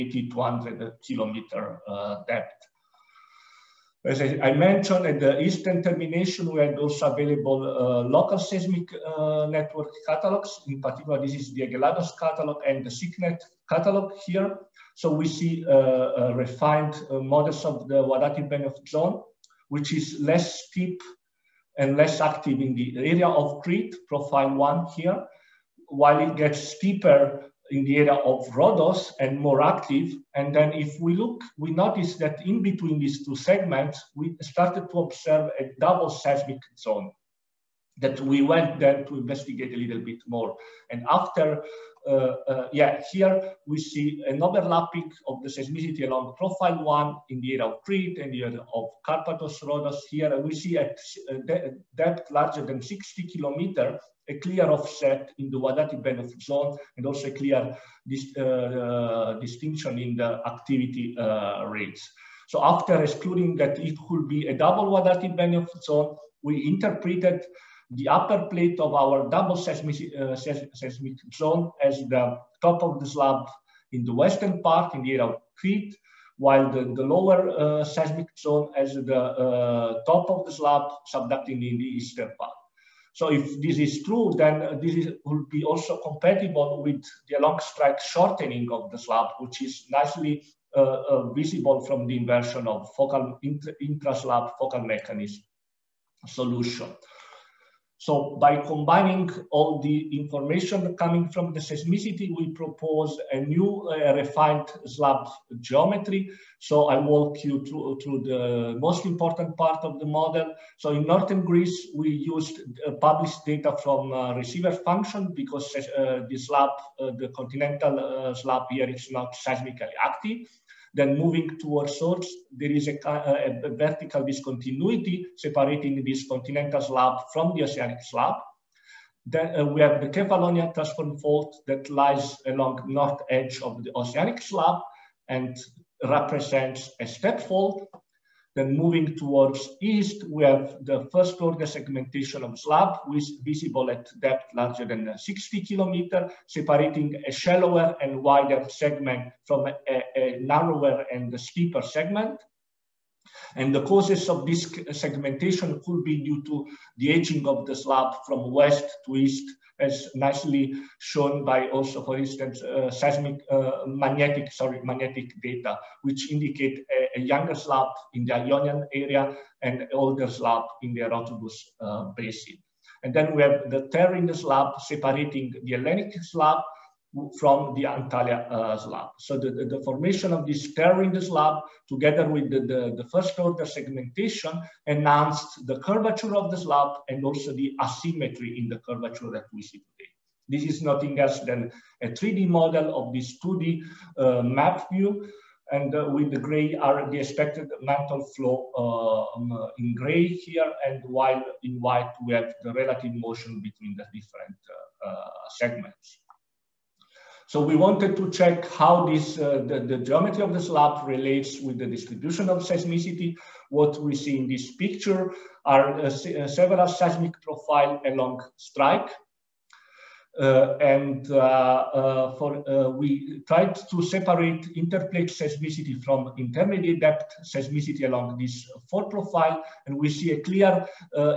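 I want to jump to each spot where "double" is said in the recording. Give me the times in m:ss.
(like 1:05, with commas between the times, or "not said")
0:35, 1:04, 1:09.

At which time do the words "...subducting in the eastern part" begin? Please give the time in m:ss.
1:21.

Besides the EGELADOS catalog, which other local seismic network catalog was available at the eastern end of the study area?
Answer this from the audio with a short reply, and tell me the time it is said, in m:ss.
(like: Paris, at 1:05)
SICNET, at 0:12.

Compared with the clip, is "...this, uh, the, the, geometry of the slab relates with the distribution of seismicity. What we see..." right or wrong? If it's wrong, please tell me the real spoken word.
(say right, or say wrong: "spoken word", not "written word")
right.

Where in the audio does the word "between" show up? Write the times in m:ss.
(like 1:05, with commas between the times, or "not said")
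0:32, 3:23.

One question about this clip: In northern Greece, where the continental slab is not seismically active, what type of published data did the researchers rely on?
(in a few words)
Receiver function.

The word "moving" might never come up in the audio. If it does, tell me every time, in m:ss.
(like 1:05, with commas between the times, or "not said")
2:01, 2:18.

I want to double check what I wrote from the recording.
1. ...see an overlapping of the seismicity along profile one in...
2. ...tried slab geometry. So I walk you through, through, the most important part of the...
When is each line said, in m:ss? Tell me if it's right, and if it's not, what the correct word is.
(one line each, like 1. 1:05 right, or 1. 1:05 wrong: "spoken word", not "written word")
1. 0:43 right
2. 1:44 wrong: "refined", not "tried".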